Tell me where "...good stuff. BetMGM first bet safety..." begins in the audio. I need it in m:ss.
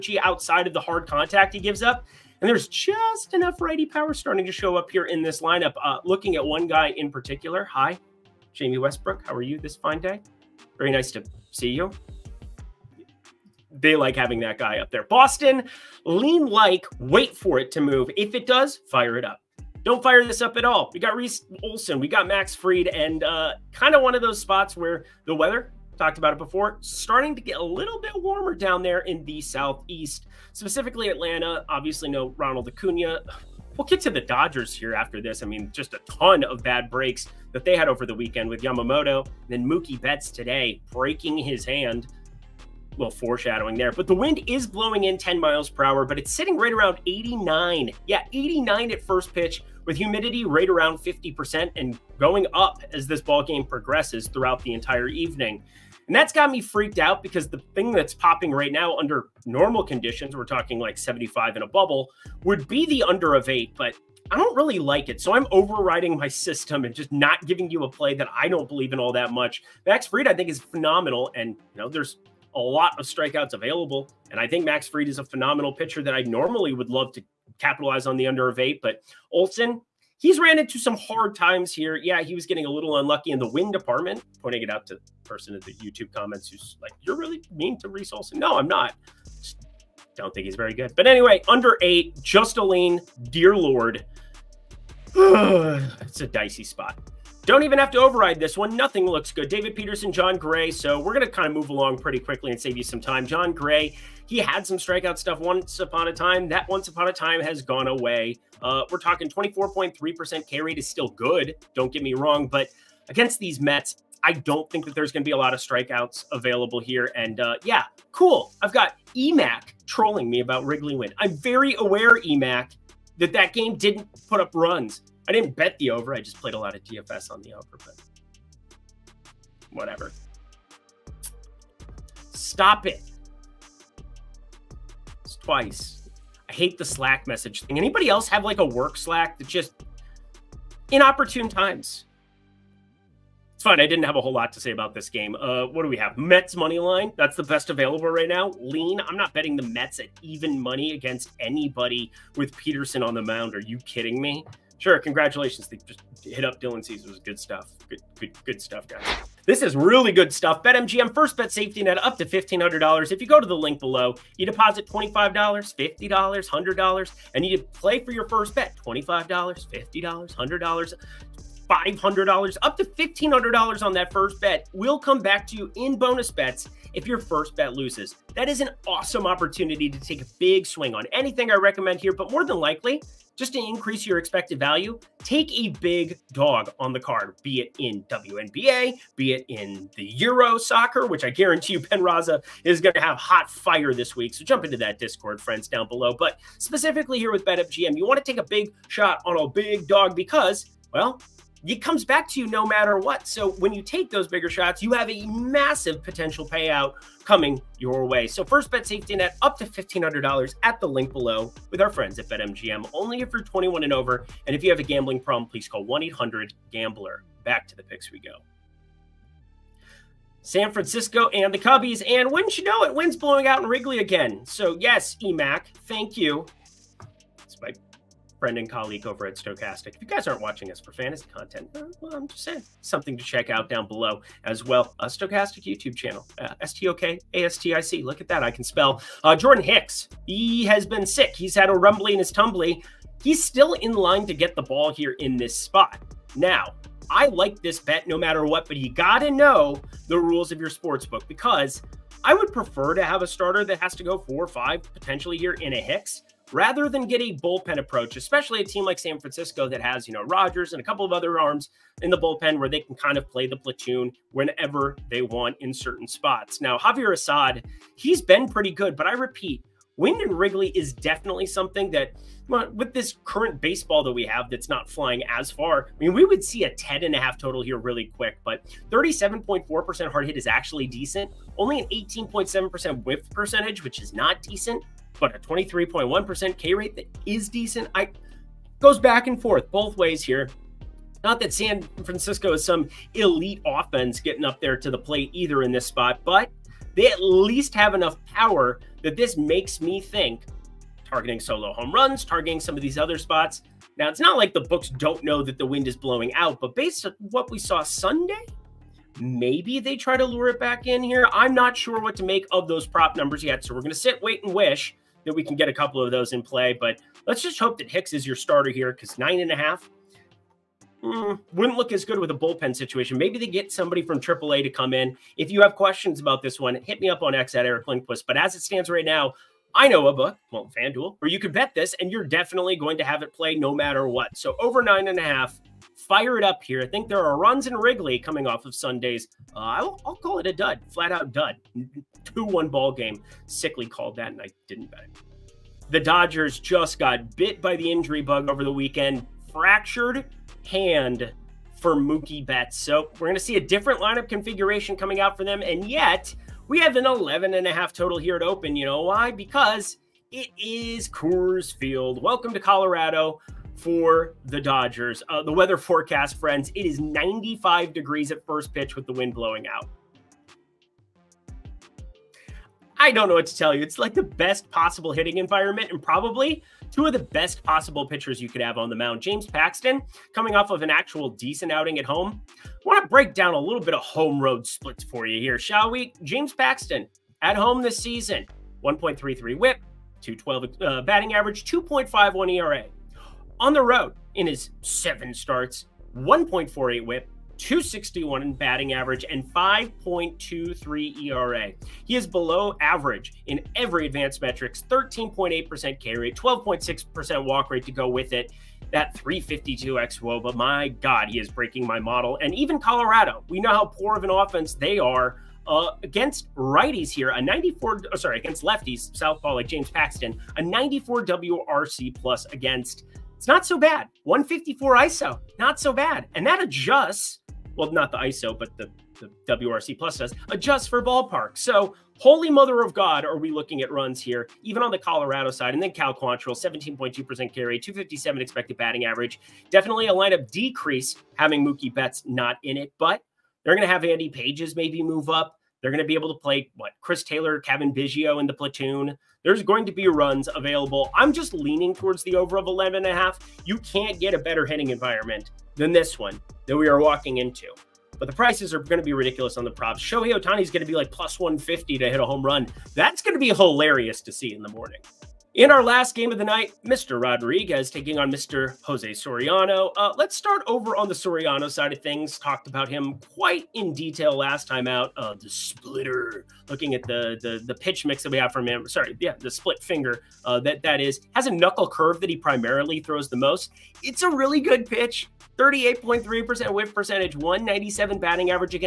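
2:40.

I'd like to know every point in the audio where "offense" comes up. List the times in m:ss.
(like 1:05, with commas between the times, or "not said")
4:53, 6:54.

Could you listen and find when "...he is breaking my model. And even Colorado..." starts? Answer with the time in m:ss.
6:51.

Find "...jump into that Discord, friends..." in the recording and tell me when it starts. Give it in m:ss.
3:14.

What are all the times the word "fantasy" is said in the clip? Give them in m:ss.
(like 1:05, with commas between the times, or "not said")
3:50.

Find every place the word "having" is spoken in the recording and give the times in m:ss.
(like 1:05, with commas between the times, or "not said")
0:14, 7:21.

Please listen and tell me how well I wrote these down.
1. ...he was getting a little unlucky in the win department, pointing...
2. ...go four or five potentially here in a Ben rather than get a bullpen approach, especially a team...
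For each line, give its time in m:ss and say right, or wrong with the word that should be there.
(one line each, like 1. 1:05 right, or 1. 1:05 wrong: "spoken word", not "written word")
1. 1:22 right
2. 4:14 wrong: "Hicks", not "Ben".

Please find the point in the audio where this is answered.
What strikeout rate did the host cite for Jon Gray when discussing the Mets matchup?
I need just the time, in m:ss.
1:49.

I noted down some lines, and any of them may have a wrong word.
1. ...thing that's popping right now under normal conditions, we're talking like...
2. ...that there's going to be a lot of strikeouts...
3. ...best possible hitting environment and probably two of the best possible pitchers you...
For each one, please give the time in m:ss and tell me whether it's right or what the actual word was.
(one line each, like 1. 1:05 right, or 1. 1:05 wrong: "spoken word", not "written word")
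1. 0:57 right
2. 1:54 right
3. 6:14 right.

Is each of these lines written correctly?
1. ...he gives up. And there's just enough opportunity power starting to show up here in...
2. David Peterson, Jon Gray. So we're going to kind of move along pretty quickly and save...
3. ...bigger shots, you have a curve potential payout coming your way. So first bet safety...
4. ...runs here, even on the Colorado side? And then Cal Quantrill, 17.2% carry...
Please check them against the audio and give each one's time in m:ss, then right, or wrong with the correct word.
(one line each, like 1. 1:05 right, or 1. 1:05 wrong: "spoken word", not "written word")
1. 0:01 wrong: "righty", not "opportunity"
2. 1:39 right
3. 3:24 wrong: "massive", not "curve"
4. 7:13 right.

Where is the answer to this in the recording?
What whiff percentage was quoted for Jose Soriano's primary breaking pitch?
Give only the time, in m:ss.
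8:05.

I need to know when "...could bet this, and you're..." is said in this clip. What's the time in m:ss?
5:31.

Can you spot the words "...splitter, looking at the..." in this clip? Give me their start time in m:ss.
7:55.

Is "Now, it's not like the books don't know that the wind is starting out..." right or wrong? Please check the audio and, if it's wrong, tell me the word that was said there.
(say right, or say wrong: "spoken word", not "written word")
wrong: "blowing", not "starting".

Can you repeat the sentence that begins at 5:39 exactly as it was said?
Uh, I'll, I'll, call it a dud, flat out dud.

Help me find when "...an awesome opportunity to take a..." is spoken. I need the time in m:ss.
2:58.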